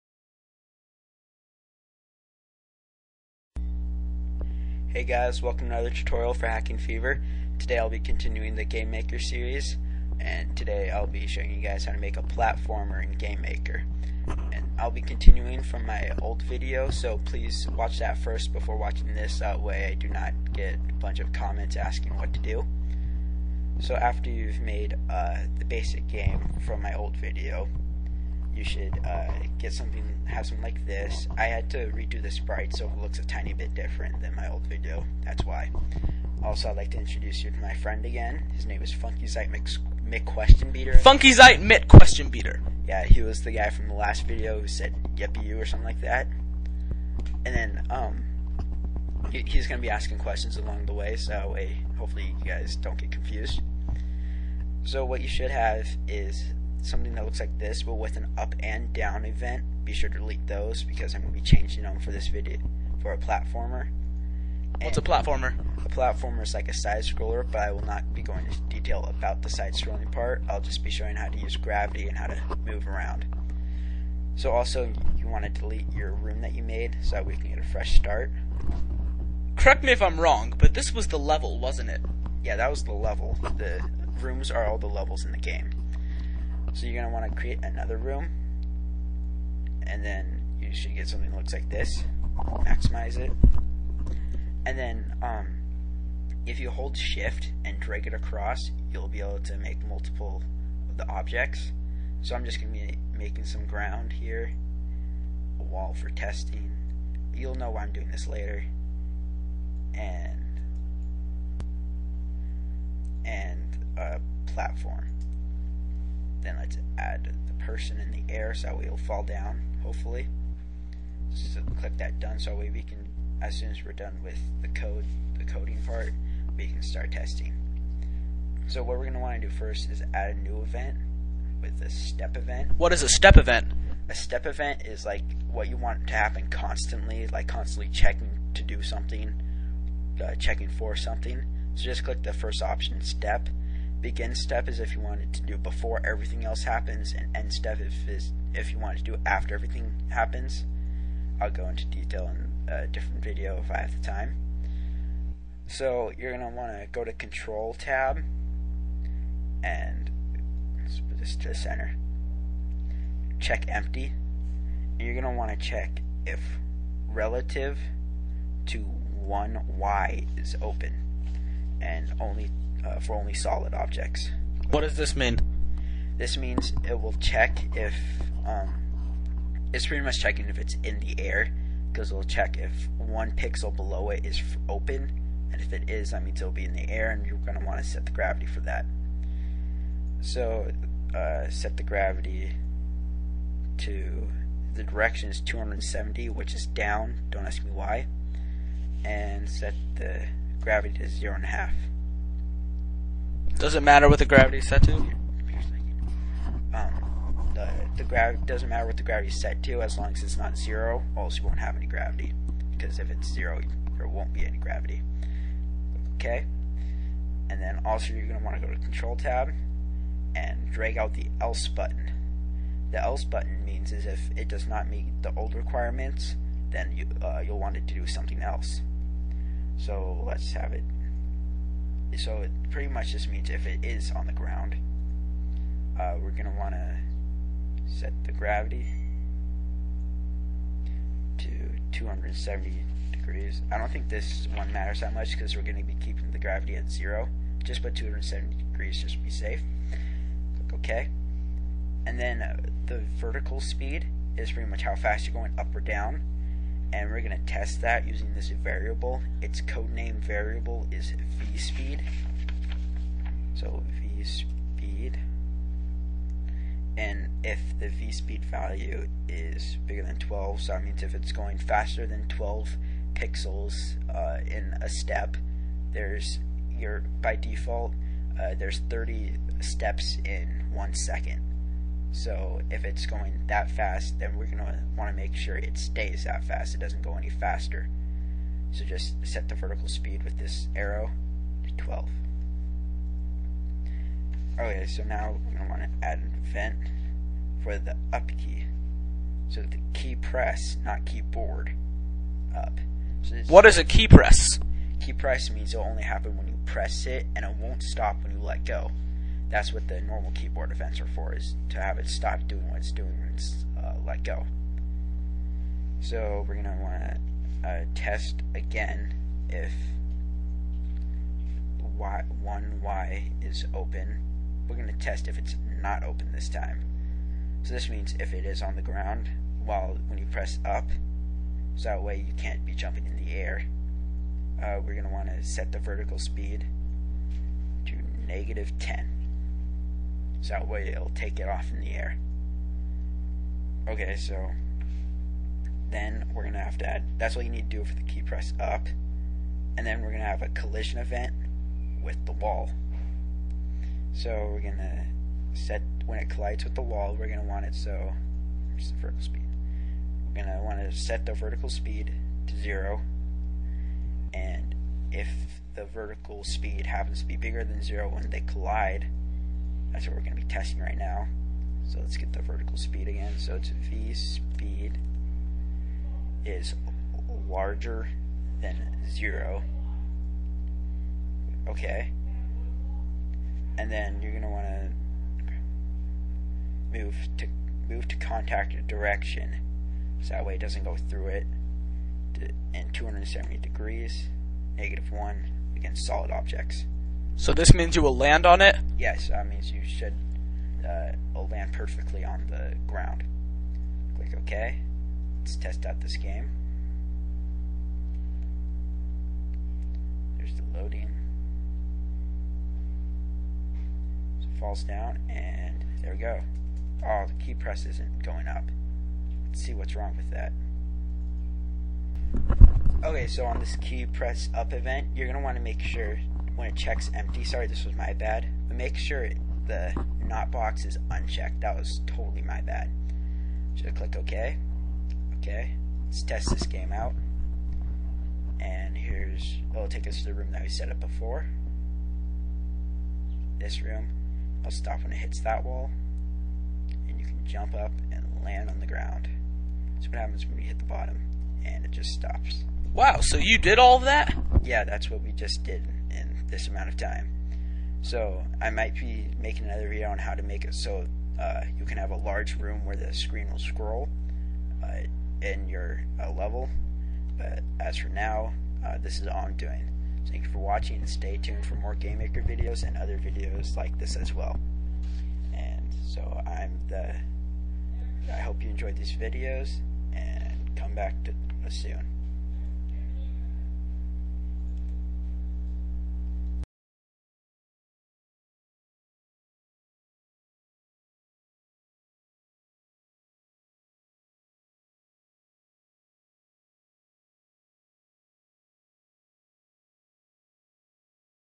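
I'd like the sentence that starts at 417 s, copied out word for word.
Oh, the key press isn't going up.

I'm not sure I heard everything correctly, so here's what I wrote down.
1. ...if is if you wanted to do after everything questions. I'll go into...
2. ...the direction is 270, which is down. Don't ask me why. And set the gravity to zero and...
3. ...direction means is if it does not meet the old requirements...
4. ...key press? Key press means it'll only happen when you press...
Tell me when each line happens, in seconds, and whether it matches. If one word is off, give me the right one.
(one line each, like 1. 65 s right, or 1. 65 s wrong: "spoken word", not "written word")
1. 147 s wrong: "happens", not "questions"
2. 194 s right
3. 223 s wrong: "button", not "direction"
4. 303 s right.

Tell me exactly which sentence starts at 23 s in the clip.
So after you've made uh, the basic game from my old video, you should uh, get something, have something like this.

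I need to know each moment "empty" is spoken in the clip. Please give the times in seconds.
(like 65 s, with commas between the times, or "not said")
163 s, 427 s.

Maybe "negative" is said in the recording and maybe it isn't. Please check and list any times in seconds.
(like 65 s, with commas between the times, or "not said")
338 s, 394 s.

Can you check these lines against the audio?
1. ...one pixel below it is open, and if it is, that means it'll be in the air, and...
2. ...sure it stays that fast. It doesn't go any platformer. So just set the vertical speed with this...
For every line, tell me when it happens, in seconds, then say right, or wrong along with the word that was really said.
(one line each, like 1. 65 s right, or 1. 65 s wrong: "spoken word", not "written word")
1. 182 s right
2. 285 s wrong: "faster", not "platformer".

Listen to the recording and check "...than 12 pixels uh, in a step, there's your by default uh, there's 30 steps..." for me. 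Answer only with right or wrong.
right.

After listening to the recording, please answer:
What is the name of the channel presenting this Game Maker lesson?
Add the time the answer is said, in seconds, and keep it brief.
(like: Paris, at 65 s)
Hacking Fever, at 6 s.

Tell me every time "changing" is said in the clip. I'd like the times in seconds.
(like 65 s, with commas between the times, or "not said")
61 s.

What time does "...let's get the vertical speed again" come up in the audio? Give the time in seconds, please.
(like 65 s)
371 s.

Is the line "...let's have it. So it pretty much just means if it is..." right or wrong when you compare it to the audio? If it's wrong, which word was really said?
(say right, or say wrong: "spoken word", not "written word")
right.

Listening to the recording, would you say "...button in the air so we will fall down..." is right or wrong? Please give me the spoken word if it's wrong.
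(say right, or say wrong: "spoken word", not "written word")
wrong: "person", not "button".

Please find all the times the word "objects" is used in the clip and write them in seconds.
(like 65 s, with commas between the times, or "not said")
101 s, 173 s, 396 s.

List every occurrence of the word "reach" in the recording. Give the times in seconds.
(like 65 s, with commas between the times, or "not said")
not said.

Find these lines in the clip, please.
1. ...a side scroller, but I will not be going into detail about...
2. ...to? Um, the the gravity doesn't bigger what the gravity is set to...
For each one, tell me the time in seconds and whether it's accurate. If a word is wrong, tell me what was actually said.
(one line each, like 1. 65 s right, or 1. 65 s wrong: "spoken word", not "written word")
1. 66 s right
2. 204 s wrong: "matter", not "bigger".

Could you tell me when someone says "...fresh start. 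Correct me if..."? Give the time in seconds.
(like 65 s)
77 s.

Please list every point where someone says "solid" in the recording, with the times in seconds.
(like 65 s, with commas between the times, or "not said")
173 s, 396 s.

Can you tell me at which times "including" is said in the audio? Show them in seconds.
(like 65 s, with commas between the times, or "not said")
not said.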